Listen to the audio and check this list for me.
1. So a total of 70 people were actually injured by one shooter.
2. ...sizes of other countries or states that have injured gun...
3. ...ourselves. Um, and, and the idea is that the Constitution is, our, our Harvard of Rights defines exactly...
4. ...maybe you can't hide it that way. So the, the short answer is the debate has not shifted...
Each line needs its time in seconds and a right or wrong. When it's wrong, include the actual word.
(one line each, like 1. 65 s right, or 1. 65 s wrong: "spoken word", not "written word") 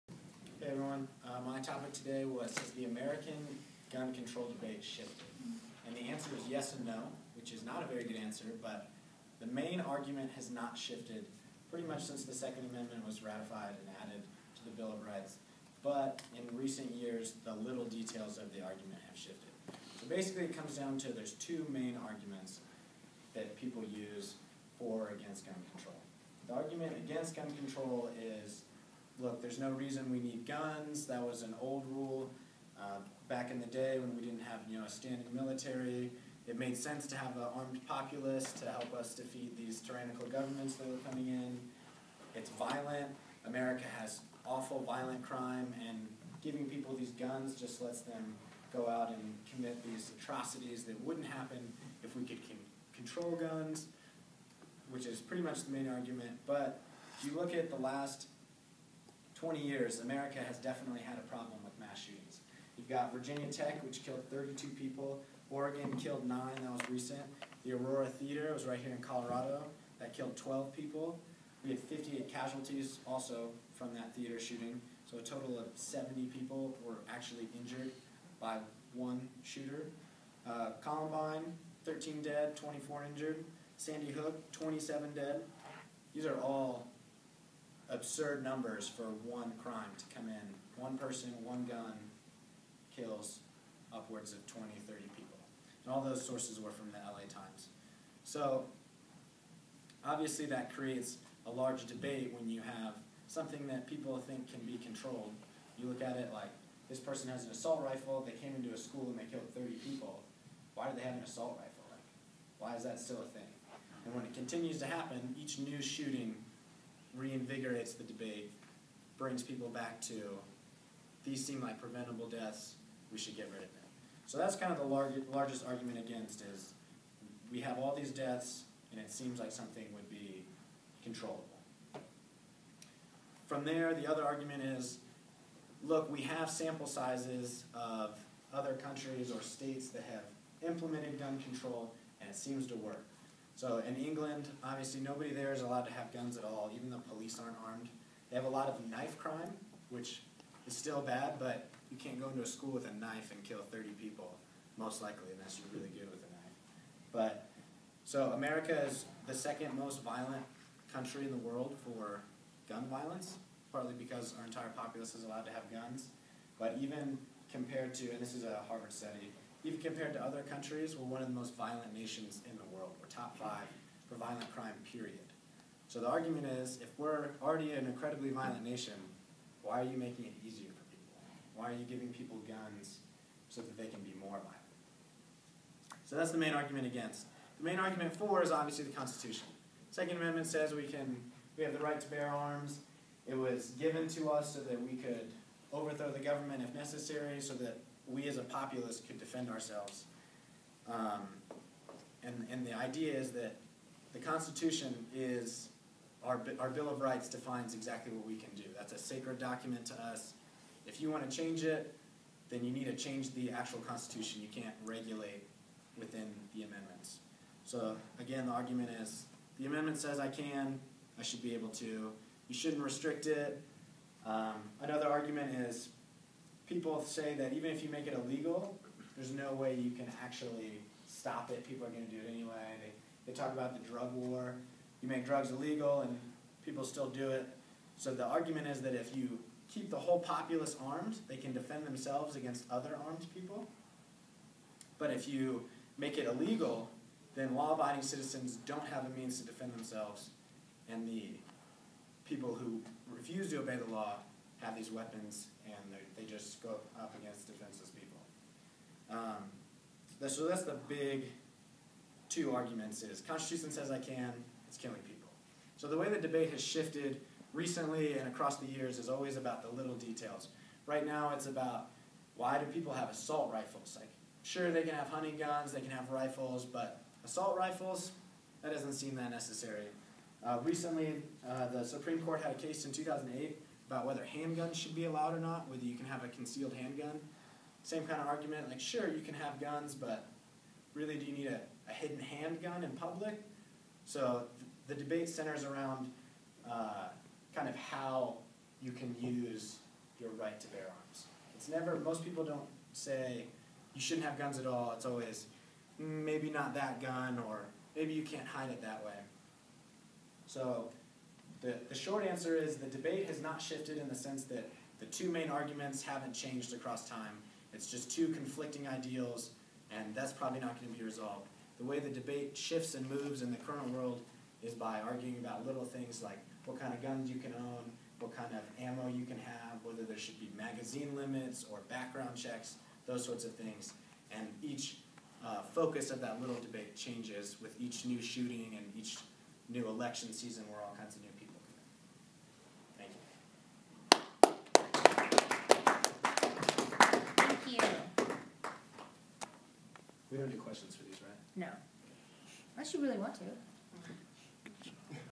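1. 75 s right
2. 136 s wrong: "implemented", not "injured"
3. 199 s wrong: "Bill", not "Harvard"
4. 307 s right.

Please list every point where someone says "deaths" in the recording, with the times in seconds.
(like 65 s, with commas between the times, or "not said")
122 s, 128 s.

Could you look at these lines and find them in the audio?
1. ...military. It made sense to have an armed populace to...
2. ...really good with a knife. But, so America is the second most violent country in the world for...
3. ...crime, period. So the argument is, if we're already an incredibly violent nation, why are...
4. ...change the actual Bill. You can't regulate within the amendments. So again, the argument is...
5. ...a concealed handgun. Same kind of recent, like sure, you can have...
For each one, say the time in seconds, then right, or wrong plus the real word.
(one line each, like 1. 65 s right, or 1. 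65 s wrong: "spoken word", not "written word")
1. 35 s right
2. 155 s right
3. 174 s right
4. 212 s wrong: "Constitution", not "Bill"
5. 286 s wrong: "argument", not "recent".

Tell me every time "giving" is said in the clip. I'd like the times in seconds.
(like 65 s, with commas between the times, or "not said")
46 s, 181 s.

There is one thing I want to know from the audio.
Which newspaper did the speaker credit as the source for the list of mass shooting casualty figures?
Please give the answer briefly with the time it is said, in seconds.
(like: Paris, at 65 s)
LA Times, at 96 s.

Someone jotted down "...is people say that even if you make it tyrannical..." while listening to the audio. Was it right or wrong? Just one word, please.
wrong.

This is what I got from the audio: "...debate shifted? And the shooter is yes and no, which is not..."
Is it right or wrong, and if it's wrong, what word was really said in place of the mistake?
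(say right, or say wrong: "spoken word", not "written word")
wrong: "answer", not "shooter".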